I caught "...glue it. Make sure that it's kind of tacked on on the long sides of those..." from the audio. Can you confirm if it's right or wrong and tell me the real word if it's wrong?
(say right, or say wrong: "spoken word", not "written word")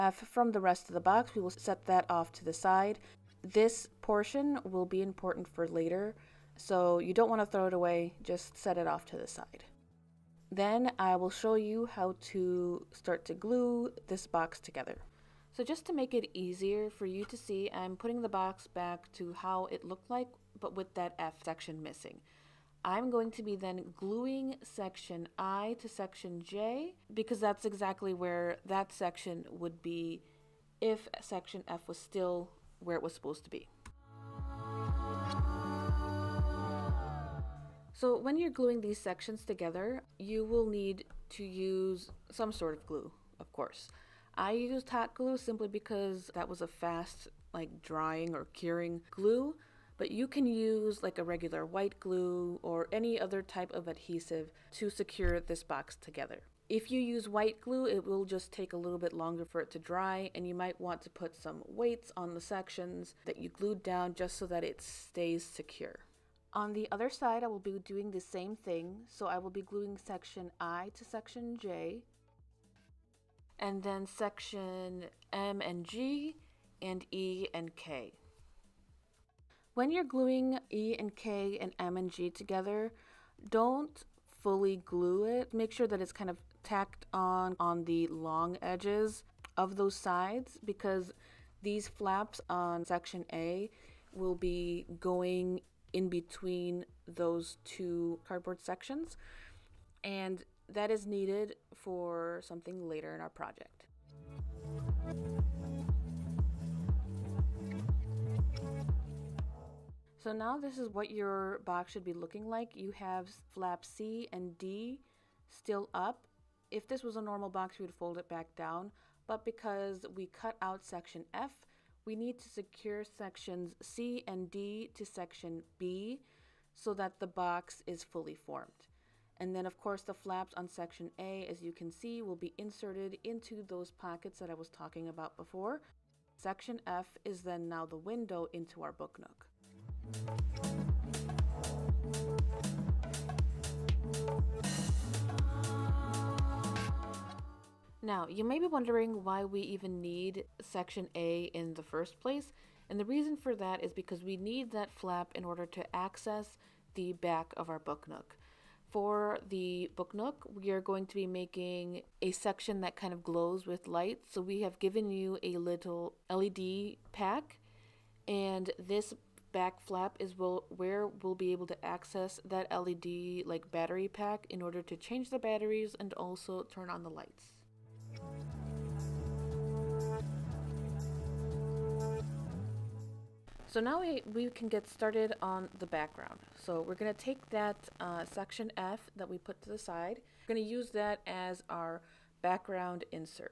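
wrong: "edges", not "sides".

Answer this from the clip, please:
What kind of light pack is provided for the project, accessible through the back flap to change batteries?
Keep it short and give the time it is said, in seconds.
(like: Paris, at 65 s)
LED pack, at 166 s.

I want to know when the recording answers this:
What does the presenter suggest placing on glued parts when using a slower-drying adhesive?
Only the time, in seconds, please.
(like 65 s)
61 s.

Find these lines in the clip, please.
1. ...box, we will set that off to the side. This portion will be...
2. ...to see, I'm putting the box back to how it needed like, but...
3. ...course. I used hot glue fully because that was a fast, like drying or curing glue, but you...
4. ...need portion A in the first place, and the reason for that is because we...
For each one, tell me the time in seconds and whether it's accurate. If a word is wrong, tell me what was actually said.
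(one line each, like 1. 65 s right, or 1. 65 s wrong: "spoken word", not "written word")
1. 1 s right
2. 17 s wrong: "looked", not "needed"
3. 43 s wrong: "simply", not "fully"
4. 150 s wrong: "section", not "portion".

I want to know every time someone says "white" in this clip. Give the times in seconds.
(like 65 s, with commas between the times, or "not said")
51 s, 57 s.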